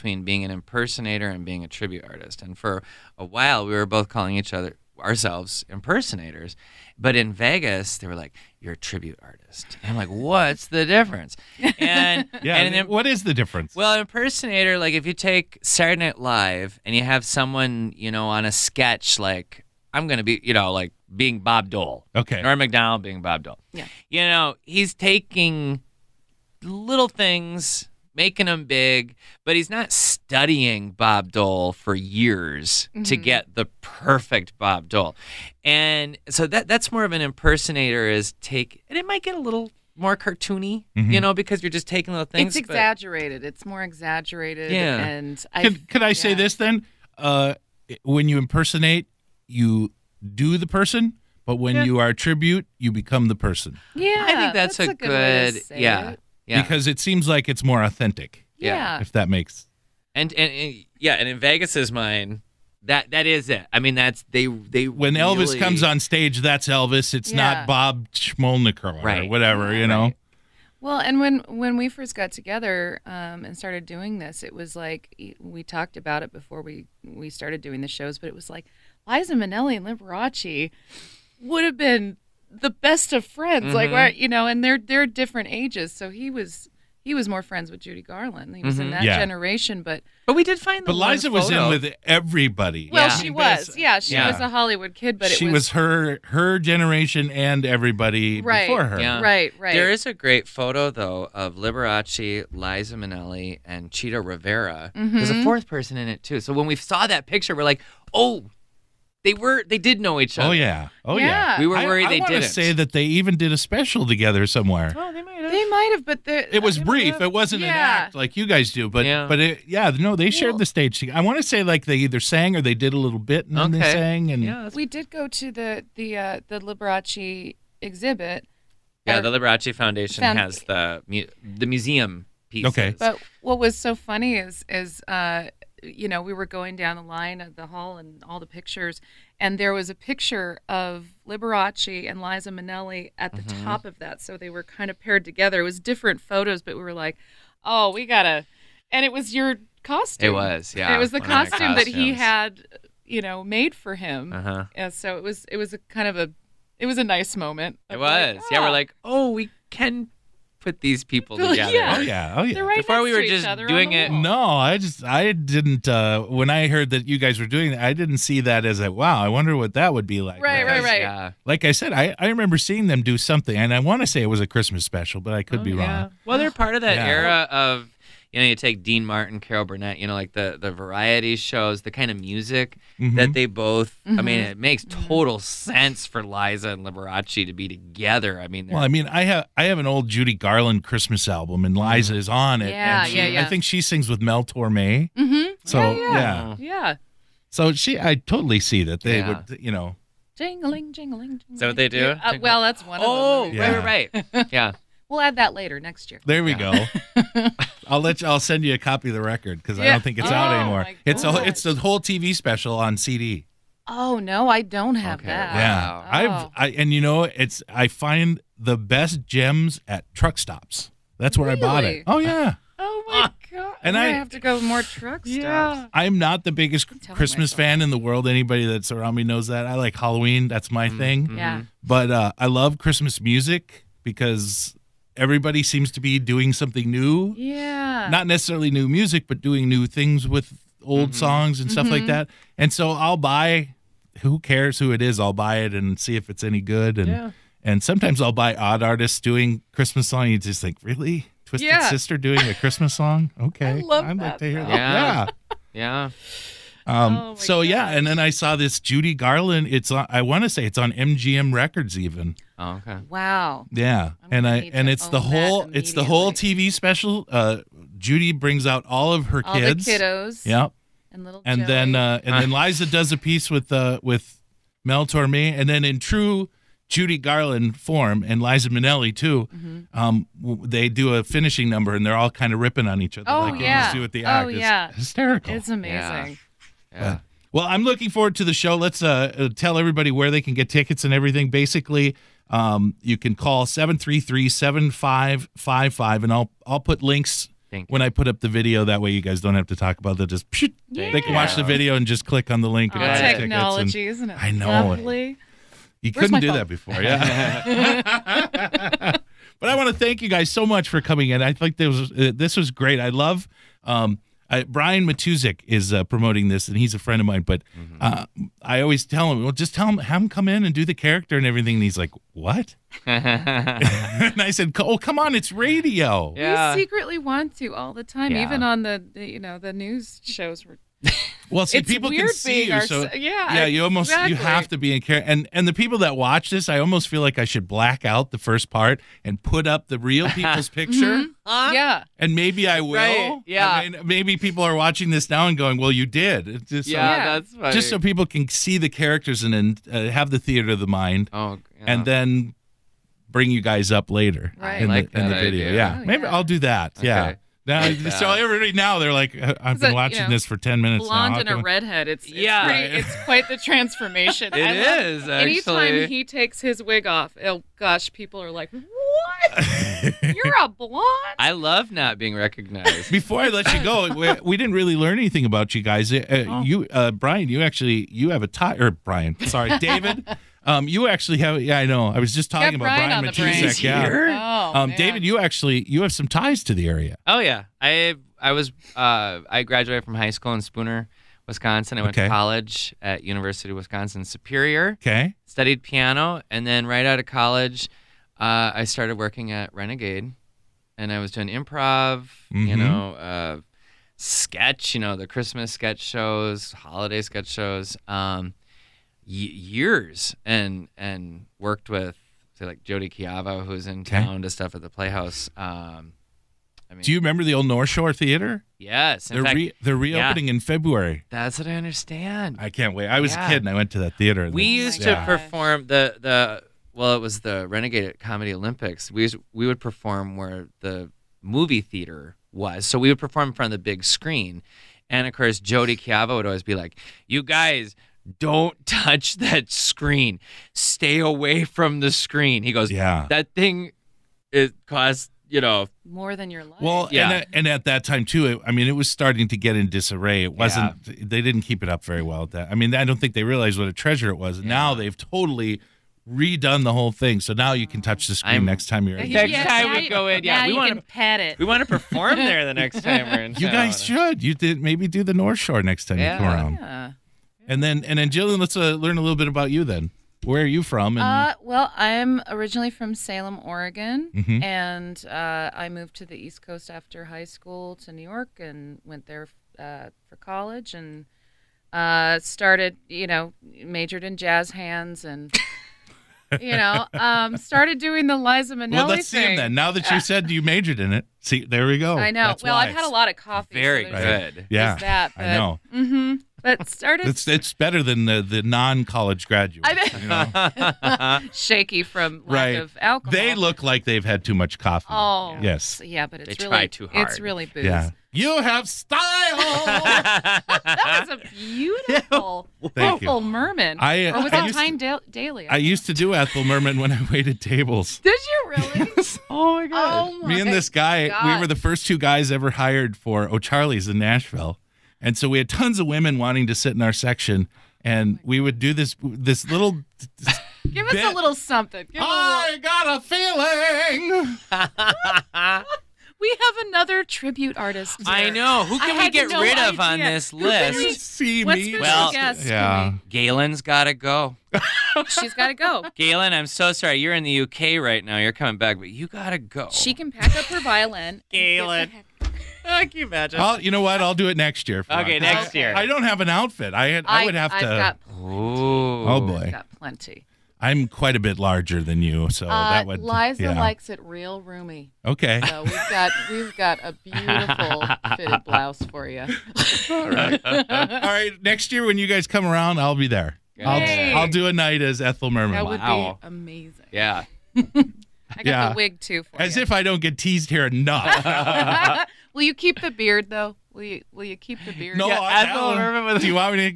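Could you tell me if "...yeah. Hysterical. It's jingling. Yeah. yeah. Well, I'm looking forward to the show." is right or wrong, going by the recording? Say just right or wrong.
wrong.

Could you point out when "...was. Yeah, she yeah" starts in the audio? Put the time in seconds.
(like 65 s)
93 s.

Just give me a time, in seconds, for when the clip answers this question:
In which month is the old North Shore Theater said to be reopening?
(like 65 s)
420 s.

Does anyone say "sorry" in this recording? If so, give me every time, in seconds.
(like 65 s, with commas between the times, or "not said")
379 s, 546 s.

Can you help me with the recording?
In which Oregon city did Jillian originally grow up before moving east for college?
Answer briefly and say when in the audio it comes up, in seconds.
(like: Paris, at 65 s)
Salem, at 473 s.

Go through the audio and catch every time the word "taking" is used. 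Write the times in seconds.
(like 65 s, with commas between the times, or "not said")
24 s, 41 s.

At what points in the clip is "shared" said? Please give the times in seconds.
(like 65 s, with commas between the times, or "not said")
120 s.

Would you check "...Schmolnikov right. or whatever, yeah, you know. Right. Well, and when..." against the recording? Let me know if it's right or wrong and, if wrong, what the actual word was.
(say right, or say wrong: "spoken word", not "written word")
right.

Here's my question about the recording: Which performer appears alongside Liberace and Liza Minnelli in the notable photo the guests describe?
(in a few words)
Chita Rivera.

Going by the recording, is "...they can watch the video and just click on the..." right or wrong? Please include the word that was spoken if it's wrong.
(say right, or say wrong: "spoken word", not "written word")
right.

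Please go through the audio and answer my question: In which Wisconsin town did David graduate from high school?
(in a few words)
Spooner.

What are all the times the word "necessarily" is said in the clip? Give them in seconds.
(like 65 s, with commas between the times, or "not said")
238 s.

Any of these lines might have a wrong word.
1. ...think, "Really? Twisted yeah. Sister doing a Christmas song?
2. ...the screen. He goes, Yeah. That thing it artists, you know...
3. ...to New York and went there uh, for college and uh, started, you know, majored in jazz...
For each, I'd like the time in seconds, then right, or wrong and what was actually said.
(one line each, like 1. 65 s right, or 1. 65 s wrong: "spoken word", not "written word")
1. 250 s right
2. 441 s wrong: "costs", not "artists"
3. 477 s right.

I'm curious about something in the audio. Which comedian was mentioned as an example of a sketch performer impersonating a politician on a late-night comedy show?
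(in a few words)
Norm Macdonald.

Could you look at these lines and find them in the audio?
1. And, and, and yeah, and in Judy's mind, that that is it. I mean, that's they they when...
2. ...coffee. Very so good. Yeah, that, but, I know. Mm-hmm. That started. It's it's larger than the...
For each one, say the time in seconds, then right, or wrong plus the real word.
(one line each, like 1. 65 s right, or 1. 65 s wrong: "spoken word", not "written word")
1. 60 s wrong: "Vegas", not "Judy"
2. 493 s wrong: "better", not "larger".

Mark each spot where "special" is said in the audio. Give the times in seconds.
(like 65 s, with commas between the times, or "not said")
113 s, 174 s, 212 s, 266 s.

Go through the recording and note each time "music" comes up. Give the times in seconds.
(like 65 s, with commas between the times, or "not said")
182 s, 233 s, 238 s.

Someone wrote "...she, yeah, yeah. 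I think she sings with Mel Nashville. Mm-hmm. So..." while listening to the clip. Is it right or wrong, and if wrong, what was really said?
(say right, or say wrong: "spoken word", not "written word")
wrong: "Torme", not "Nashville".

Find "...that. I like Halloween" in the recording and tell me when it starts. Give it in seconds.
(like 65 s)
229 s.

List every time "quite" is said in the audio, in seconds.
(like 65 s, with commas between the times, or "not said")
363 s, 561 s.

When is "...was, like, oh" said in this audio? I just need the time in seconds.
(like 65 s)
157 s.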